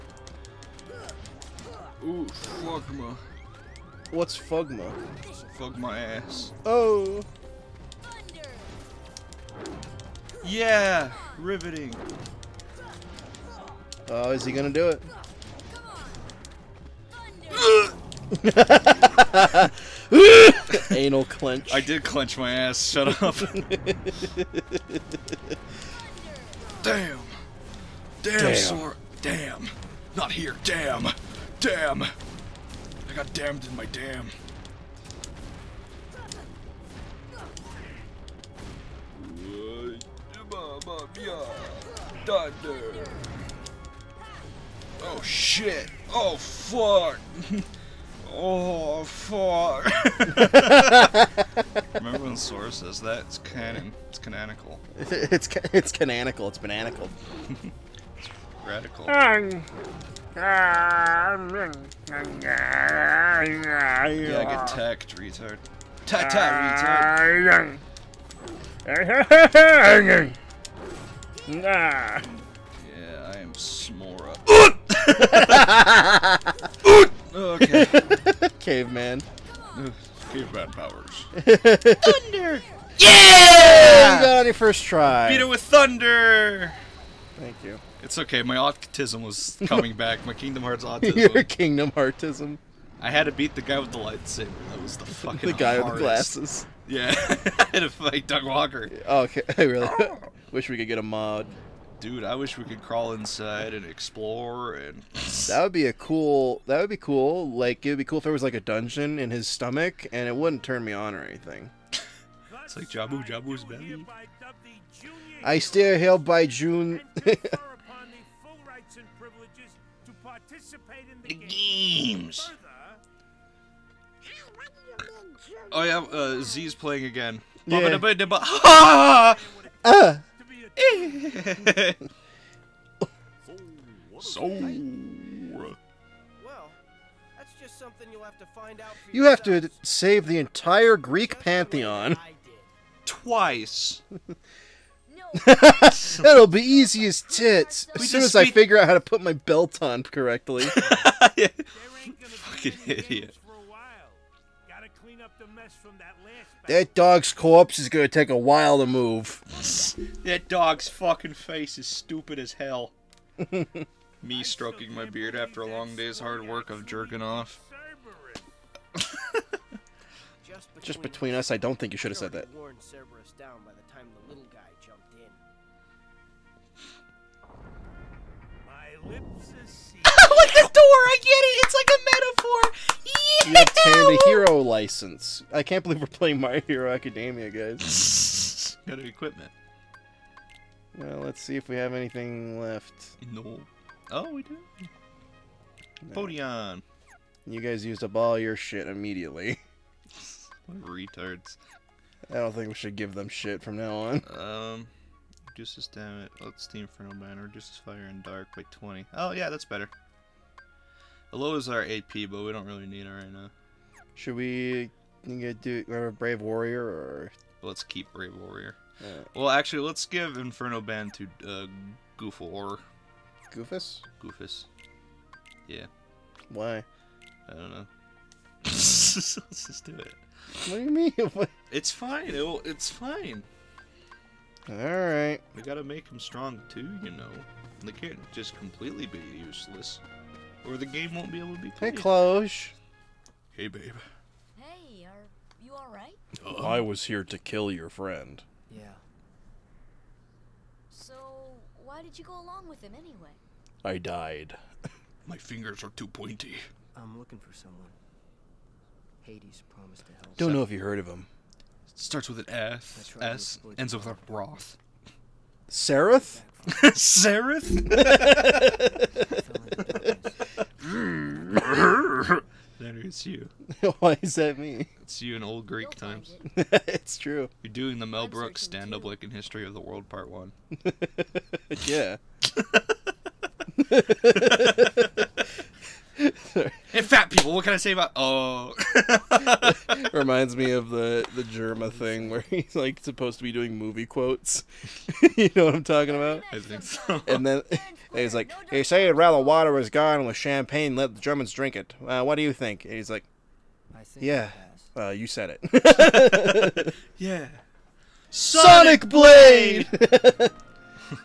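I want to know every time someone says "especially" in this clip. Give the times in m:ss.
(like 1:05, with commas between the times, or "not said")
not said.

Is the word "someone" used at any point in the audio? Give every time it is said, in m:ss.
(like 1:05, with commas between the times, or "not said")
4:17.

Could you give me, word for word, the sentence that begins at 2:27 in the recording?
As soon as I figure out how to put my belt on correctly.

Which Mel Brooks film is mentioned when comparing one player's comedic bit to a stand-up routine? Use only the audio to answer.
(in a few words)
History of the World Part 1.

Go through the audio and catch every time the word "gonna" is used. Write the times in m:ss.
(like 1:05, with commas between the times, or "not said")
0:14, 2:37.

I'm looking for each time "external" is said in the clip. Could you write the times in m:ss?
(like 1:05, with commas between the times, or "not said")
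not said.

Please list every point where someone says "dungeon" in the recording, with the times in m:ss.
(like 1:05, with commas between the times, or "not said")
1:48.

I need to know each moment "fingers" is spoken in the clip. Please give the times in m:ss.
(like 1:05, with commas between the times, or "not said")
4:15.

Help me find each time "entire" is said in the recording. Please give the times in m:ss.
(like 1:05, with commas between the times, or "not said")
2:20.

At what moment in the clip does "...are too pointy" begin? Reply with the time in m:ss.
4:15.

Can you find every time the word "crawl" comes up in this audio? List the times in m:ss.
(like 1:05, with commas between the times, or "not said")
1:42.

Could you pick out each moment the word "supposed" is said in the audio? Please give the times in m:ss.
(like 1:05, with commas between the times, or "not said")
4:53.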